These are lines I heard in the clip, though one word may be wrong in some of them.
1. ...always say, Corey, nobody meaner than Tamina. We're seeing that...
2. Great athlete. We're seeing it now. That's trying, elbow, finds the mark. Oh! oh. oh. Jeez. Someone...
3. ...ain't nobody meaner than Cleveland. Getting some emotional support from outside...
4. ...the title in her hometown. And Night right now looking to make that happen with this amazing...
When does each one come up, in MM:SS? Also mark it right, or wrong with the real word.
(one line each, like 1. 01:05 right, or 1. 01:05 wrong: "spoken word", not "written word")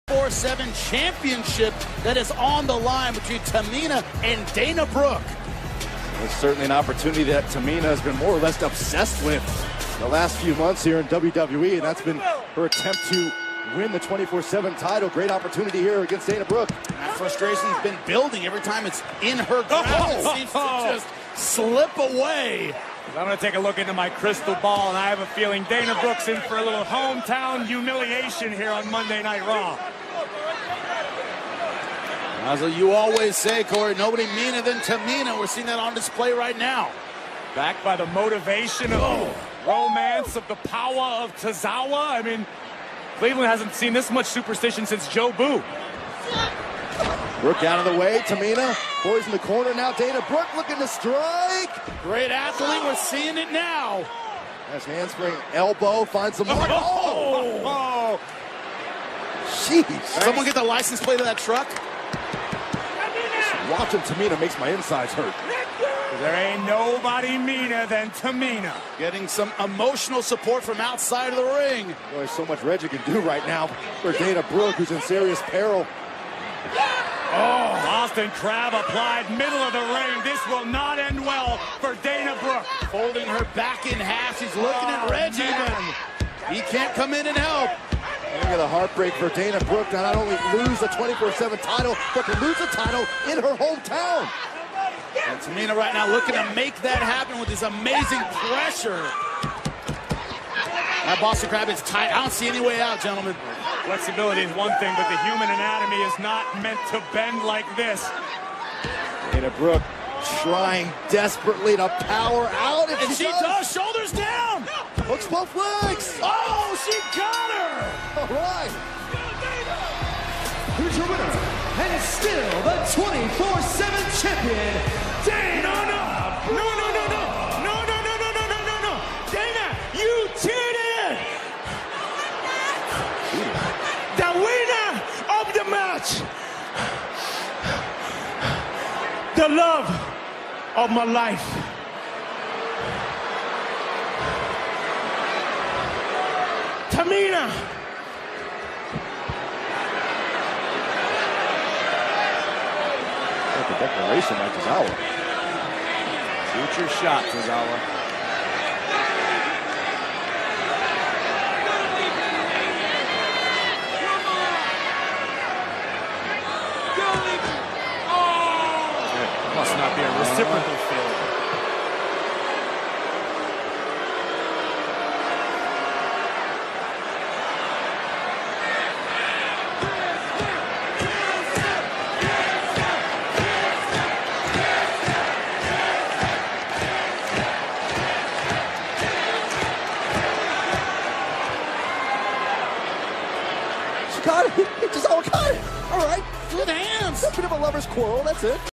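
1. 00:32 right
2. 00:52 wrong: "handspring", not "trying"
3. 01:06 wrong: "Tamina", not "Cleveland"
4. 01:32 wrong: "Tamina", not "Night".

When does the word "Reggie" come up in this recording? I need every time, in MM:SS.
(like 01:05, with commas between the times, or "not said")
01:12, 01:25.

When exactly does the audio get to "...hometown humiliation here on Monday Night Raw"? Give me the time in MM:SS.
00:26.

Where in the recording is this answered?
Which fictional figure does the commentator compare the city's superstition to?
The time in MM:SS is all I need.
00:45.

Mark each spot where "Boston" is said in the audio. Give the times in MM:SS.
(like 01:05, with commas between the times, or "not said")
01:17, 01:41.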